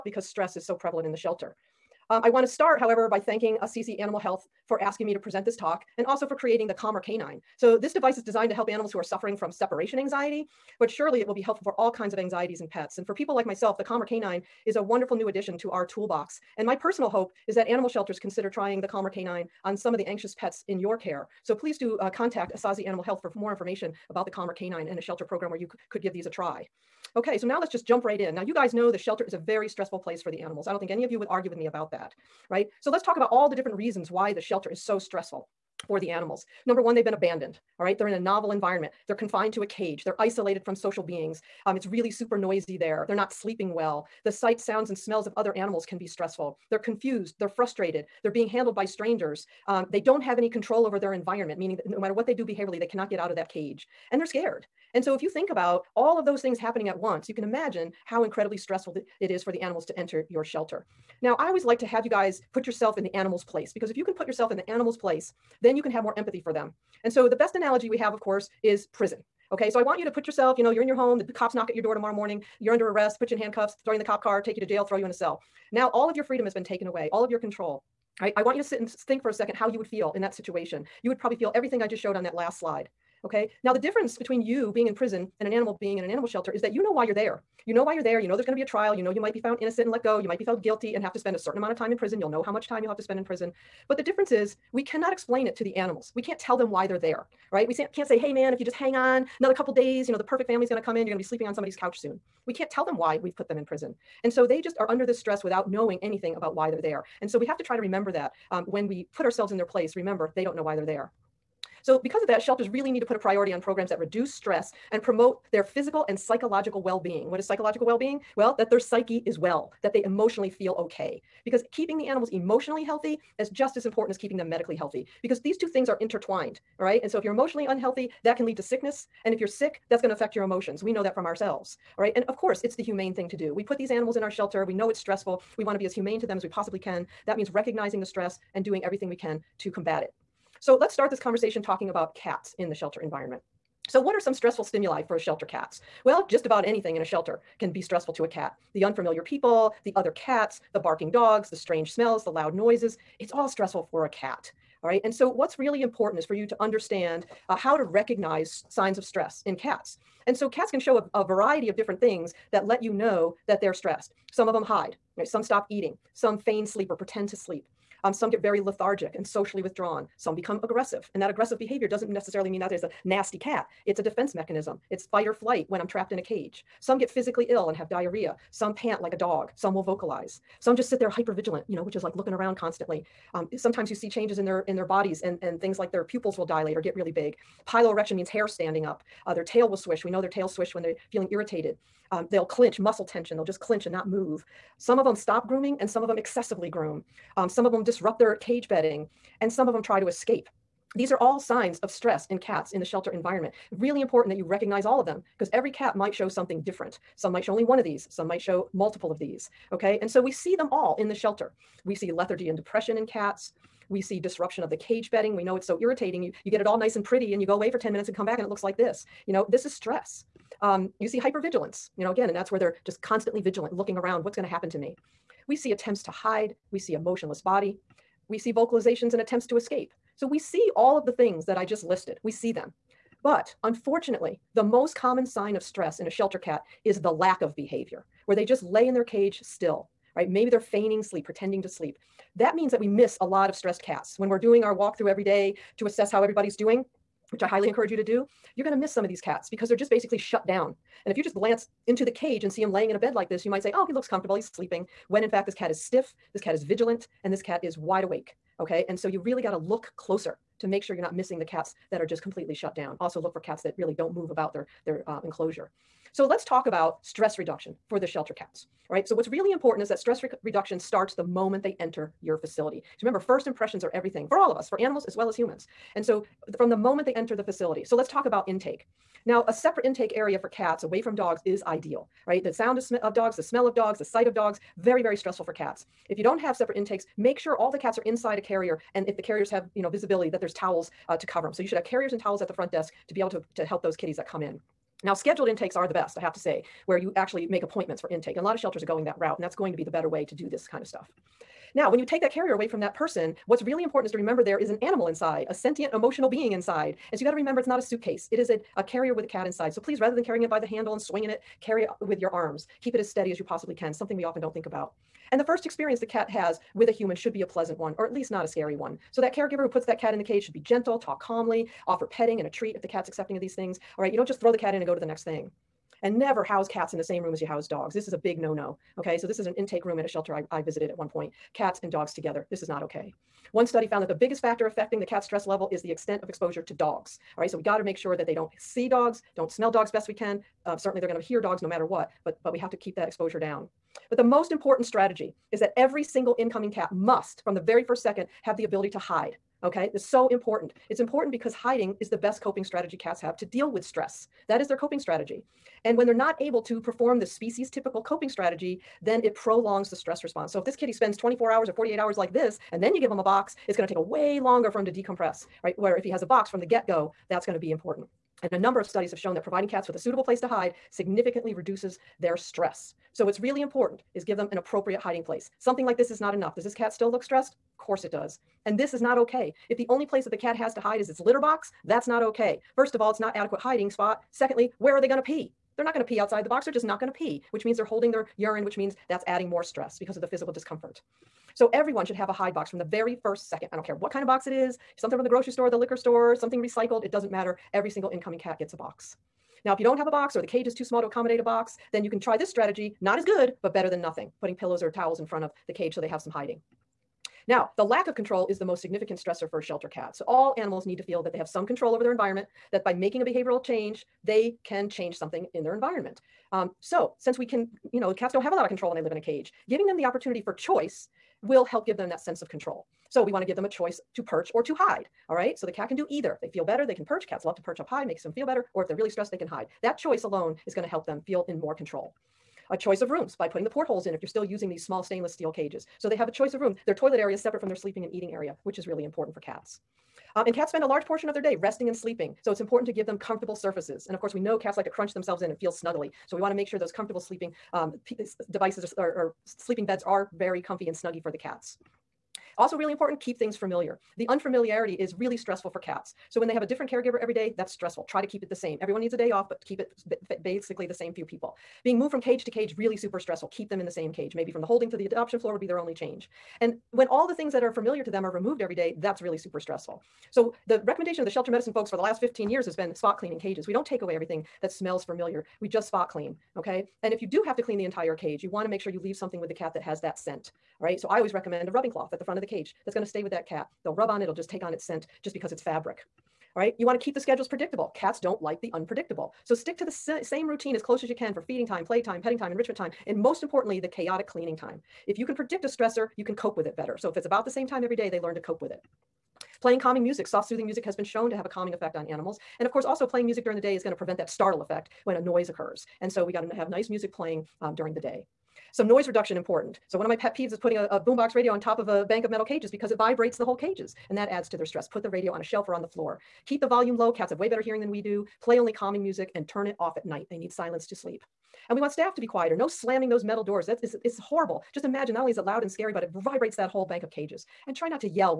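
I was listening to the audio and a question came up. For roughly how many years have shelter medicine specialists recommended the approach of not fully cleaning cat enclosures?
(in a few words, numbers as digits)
15 years.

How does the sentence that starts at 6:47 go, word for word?
Now, the lack of control is the most significant stressor for shelter cats.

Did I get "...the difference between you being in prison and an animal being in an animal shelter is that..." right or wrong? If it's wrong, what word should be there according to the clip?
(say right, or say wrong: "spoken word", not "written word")
right.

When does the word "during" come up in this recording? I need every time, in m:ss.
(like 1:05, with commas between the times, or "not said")
8:23, 8:27.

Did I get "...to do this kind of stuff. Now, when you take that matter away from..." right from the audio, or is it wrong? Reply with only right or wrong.
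wrong.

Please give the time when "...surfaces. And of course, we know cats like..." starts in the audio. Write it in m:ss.
7:23.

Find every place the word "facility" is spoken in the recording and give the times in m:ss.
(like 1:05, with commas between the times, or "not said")
4:32, 4:37.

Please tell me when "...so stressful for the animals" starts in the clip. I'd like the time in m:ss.
0:34.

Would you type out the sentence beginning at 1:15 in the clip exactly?
Now, all of your freedom has been taken away, all of your control.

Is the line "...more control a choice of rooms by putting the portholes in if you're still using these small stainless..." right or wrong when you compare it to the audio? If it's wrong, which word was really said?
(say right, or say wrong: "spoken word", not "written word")
right.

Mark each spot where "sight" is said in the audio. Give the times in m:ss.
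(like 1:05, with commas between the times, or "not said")
0:44, 4:44.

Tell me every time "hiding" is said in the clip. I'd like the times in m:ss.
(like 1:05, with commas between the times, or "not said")
5:51, 6:14, 6:23, 6:46.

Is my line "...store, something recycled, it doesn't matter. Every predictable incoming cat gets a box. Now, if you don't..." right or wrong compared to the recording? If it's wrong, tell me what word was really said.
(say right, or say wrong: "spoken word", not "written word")
wrong: "single", not "predictable".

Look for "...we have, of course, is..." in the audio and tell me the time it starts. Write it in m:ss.
1:07.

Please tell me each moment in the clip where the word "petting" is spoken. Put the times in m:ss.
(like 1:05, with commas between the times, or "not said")
5:22, 8:12.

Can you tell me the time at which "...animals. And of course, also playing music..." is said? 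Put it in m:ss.
8:22.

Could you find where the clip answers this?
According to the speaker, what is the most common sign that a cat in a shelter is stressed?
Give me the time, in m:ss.
3:57.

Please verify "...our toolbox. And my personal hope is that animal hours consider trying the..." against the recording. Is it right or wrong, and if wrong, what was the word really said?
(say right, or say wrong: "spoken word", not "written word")
wrong: "shelters", not "hours".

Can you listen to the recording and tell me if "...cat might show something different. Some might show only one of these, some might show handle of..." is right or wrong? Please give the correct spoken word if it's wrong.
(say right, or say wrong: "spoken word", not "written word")
wrong: "multiple", not "handle".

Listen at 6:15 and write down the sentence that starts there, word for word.
Something like this is not enough.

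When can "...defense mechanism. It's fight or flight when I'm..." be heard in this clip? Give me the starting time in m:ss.
2:54.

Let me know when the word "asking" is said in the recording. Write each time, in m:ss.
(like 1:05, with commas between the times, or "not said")
0:04.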